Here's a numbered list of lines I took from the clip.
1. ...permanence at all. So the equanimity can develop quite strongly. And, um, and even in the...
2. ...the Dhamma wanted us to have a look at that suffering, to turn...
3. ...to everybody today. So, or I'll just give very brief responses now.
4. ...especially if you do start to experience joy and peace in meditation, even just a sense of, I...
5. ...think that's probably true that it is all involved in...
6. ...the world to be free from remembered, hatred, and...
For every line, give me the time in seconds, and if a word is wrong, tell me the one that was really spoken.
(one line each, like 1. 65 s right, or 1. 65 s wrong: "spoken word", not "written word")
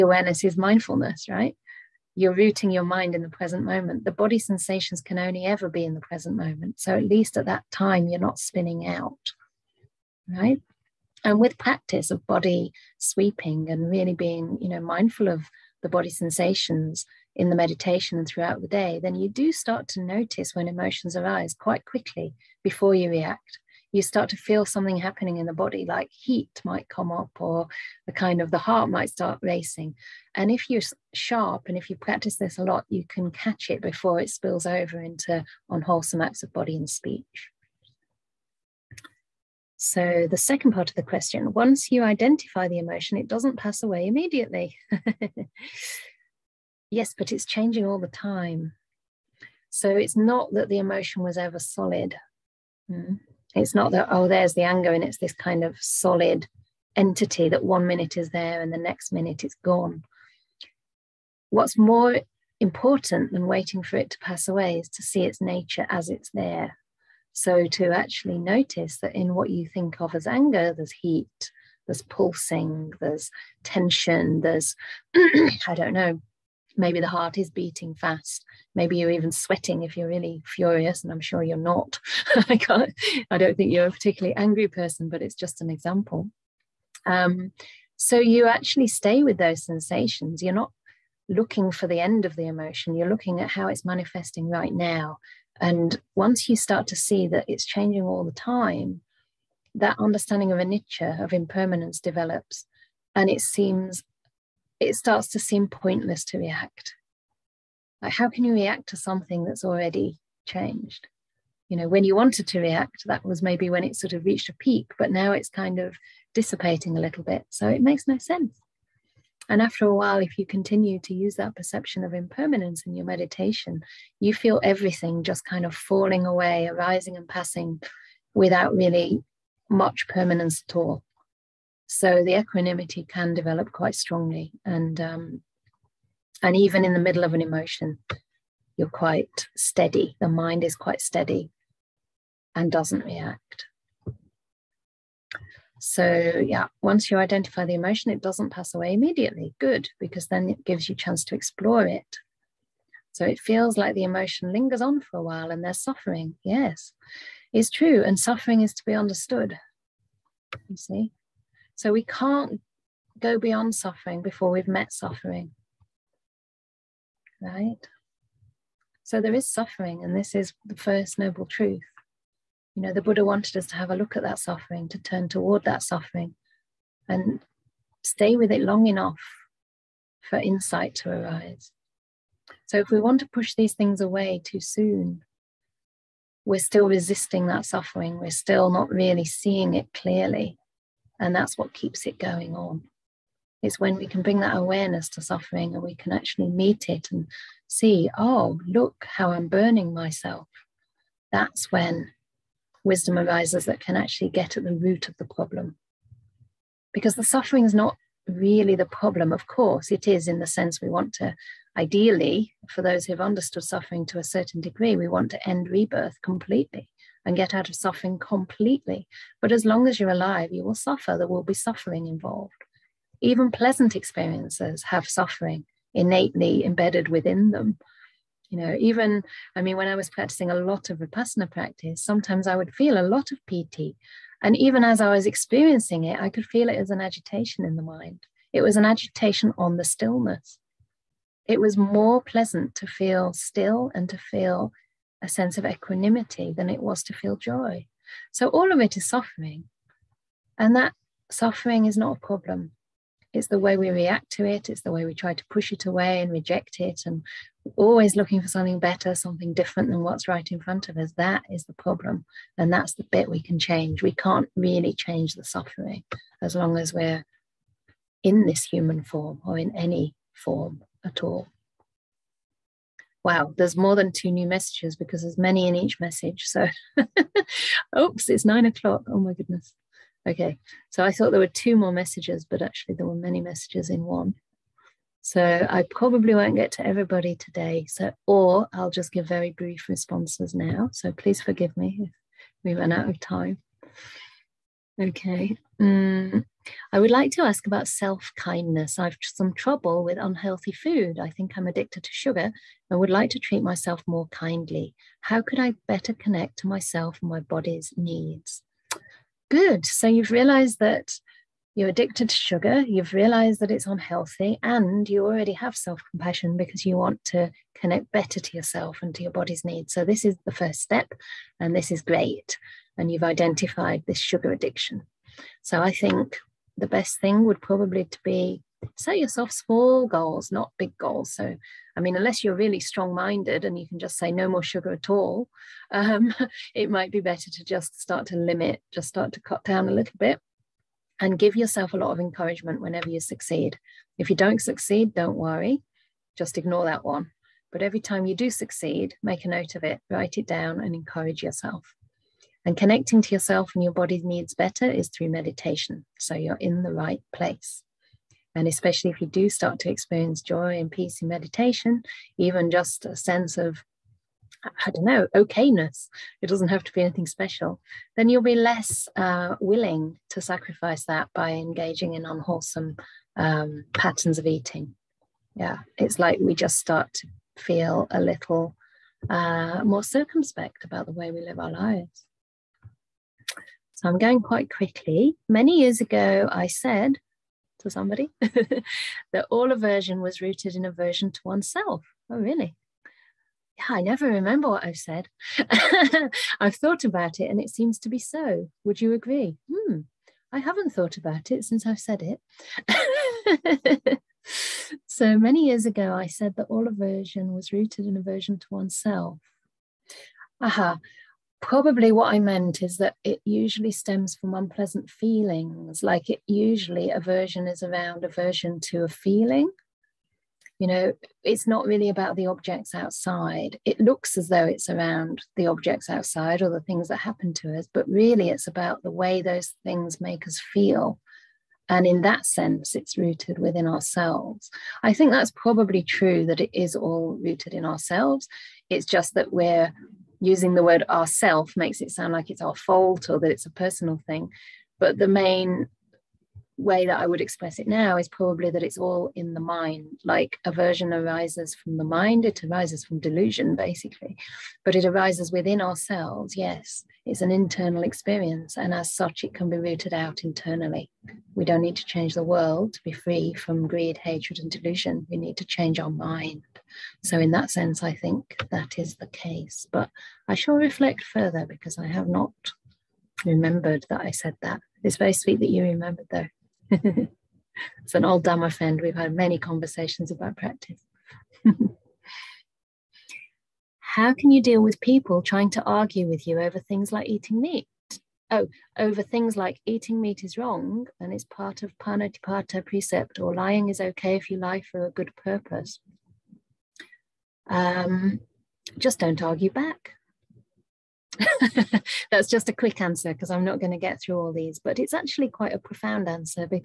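1. 130 s right
2. 172 s wrong: "Buddha", not "Dhamma"
3. 286 s right
4. 358 s right
5. 435 s wrong: "rooted", not "involved"
6. 462 s wrong: "greed", not "remembered".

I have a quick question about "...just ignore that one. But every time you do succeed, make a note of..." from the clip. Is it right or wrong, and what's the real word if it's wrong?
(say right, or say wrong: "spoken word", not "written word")
right.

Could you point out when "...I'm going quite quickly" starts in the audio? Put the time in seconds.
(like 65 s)
384 s.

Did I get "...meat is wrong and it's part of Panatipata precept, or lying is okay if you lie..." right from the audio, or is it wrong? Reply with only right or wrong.
right.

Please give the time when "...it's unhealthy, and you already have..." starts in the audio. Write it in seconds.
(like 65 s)
313 s.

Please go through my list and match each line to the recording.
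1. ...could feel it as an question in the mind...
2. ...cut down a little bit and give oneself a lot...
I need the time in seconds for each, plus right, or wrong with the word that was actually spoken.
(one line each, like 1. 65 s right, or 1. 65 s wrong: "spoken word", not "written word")
1. 236 s wrong: "agitation", not "question"
2. 339 s wrong: "yourself", not "oneself".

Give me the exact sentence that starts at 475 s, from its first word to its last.
It's very sweet that you remembered, though.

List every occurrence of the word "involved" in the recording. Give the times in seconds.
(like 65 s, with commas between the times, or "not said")
222 s.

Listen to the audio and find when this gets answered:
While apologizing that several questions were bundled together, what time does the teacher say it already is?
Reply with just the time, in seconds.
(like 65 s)
278 s.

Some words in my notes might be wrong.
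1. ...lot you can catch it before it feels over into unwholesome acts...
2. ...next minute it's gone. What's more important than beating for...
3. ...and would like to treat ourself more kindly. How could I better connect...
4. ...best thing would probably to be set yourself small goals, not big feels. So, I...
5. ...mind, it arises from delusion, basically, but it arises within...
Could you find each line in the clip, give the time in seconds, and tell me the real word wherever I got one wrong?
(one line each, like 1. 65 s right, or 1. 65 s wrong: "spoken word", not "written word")
1. 32 s wrong: "spills", not "feels"
2. 58 s wrong: "waiting", not "beating"
3. 302 s wrong: "myself", not "ourself"
4. 326 s wrong: "goals", not "feels"
5. 452 s right.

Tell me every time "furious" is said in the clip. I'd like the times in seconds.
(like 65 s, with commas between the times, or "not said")
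80 s.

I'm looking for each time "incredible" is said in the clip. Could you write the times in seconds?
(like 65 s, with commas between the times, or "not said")
not said.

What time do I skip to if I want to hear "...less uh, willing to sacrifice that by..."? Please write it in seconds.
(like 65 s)
368 s.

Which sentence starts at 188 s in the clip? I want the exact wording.
We're still not really seeing it clearly.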